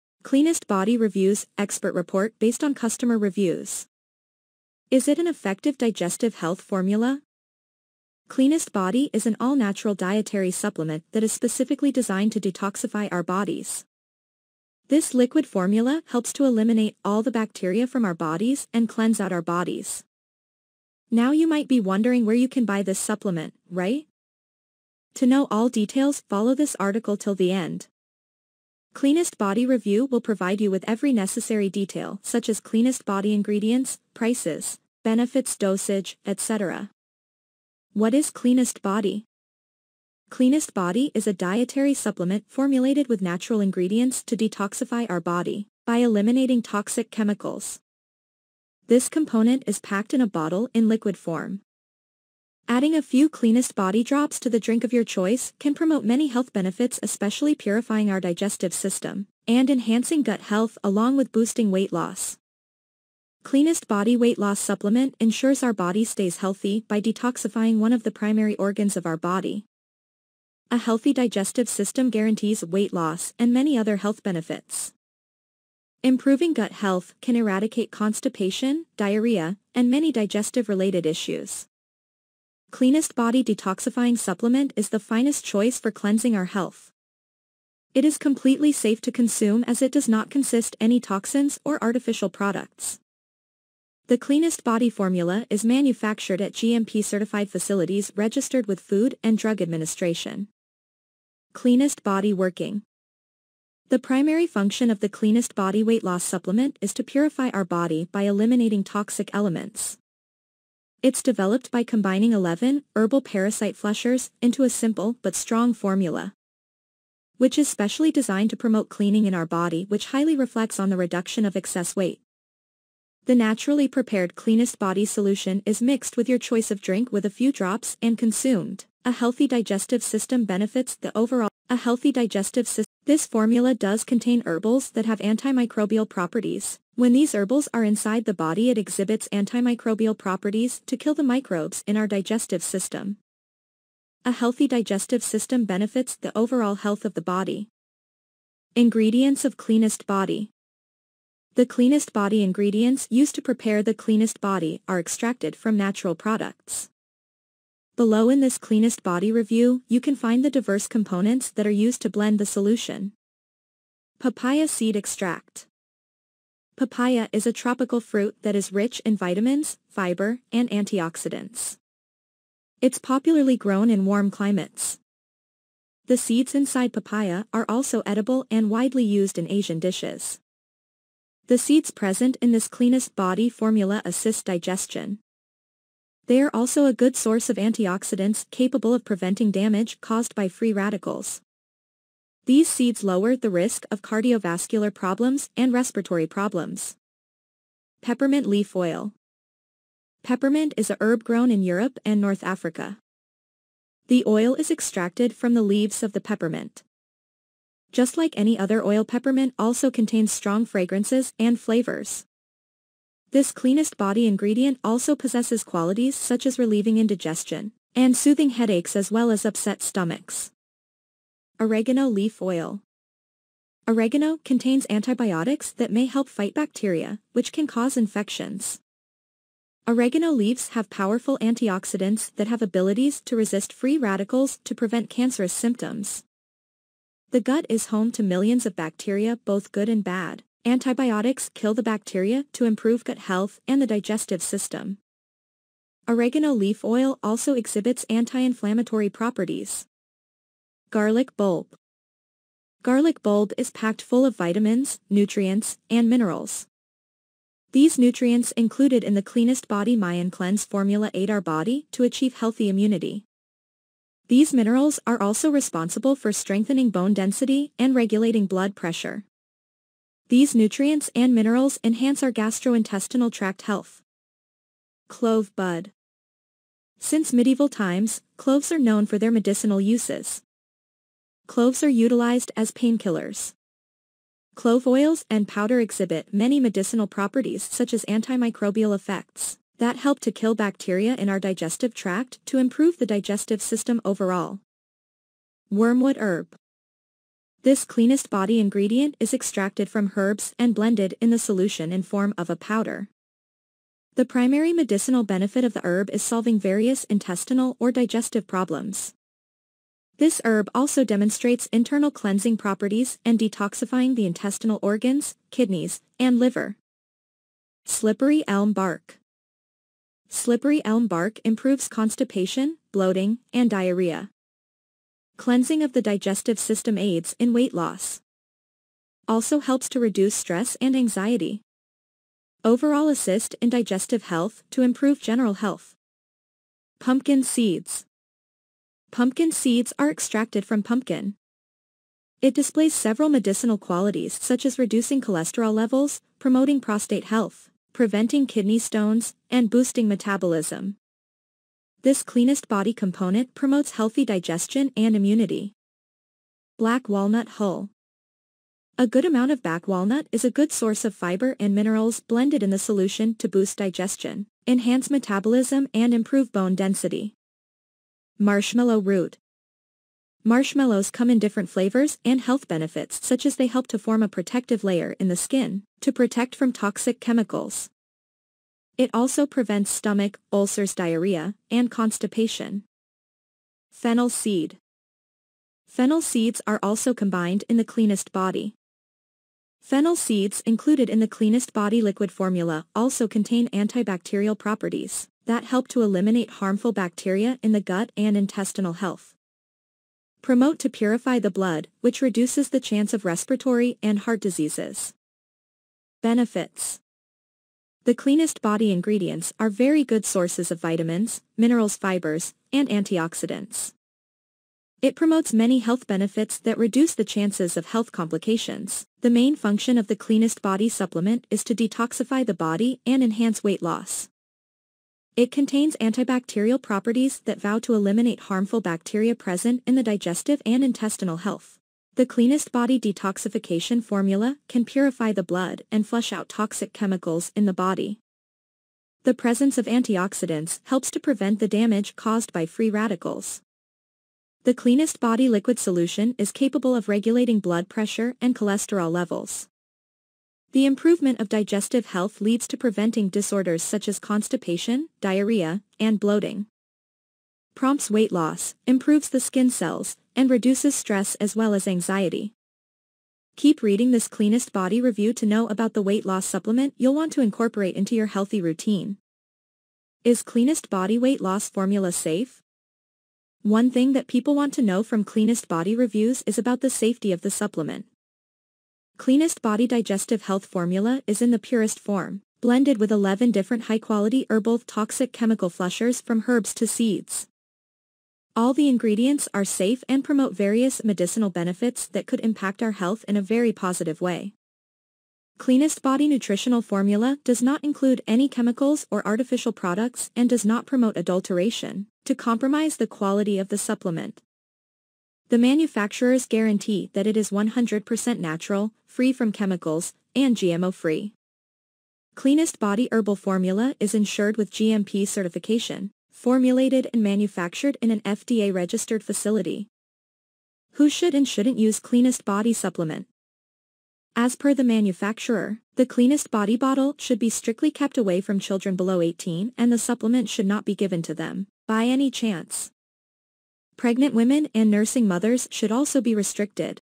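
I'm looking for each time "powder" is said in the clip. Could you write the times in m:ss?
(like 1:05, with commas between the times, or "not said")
4:45, 5:02.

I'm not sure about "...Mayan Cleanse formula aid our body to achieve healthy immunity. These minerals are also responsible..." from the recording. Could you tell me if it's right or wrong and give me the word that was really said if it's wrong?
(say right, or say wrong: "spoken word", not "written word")
right.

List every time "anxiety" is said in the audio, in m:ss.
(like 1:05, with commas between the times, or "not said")
5:30, 7:41.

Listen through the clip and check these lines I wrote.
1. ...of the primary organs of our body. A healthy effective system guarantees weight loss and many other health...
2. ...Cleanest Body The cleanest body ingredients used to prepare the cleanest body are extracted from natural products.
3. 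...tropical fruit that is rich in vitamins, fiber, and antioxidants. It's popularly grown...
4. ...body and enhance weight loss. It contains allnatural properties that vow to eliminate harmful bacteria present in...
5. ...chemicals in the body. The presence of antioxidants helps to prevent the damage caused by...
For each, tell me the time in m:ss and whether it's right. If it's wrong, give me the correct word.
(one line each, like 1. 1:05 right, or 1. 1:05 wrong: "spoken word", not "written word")
1. 1:07 wrong: "digestive", not "effective"
2. 2:29 right
3. 2:47 right
4. 7:02 wrong: "antibacterial", not "allnatural"
5. 7:16 right.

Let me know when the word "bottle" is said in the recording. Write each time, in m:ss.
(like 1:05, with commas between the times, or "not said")
0:50, 8:46.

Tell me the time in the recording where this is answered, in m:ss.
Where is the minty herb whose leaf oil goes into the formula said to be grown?
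3:21.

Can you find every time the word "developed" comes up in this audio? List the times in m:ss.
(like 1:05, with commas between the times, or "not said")
1:51.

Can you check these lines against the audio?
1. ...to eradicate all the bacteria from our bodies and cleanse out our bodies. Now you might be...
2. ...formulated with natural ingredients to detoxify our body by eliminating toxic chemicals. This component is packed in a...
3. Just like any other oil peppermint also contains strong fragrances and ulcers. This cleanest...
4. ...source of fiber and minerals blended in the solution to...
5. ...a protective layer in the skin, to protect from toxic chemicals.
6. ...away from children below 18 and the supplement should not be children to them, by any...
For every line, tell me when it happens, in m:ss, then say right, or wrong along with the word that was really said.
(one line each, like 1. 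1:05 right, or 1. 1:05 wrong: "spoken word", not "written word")
1. 0:16 wrong: "eliminate", not "eradicate"
2. 0:42 right
3. 3:27 wrong: "flavors", not "ulcers"
4. 6:00 right
5. 6:14 right
6. 8:48 wrong: "given", not "children".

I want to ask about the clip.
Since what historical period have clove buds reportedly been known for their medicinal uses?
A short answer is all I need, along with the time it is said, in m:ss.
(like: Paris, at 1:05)
Medieval times, at 4:37.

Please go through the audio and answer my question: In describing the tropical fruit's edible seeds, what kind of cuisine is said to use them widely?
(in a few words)
Asian dishes.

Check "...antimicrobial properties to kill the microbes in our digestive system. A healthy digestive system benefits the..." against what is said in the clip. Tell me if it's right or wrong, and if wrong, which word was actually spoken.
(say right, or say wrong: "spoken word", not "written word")
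right.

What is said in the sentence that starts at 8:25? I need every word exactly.
The manufacturers guarantee that it is 100% natural, free from chemicals, and GMO-free.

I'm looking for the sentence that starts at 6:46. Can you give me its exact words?
Benefits the cleanest body ingredients are very good sources of vitamins, minerals fibers, and antioxidants.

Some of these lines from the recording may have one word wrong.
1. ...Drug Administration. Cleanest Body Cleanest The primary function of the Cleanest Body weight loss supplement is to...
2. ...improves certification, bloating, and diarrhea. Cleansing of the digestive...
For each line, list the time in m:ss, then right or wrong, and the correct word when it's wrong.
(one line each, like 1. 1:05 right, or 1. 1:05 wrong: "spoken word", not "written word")
1. 1:39 wrong: "Working", not "Cleanest"
2. 5:21 wrong: "constipation", not "certification".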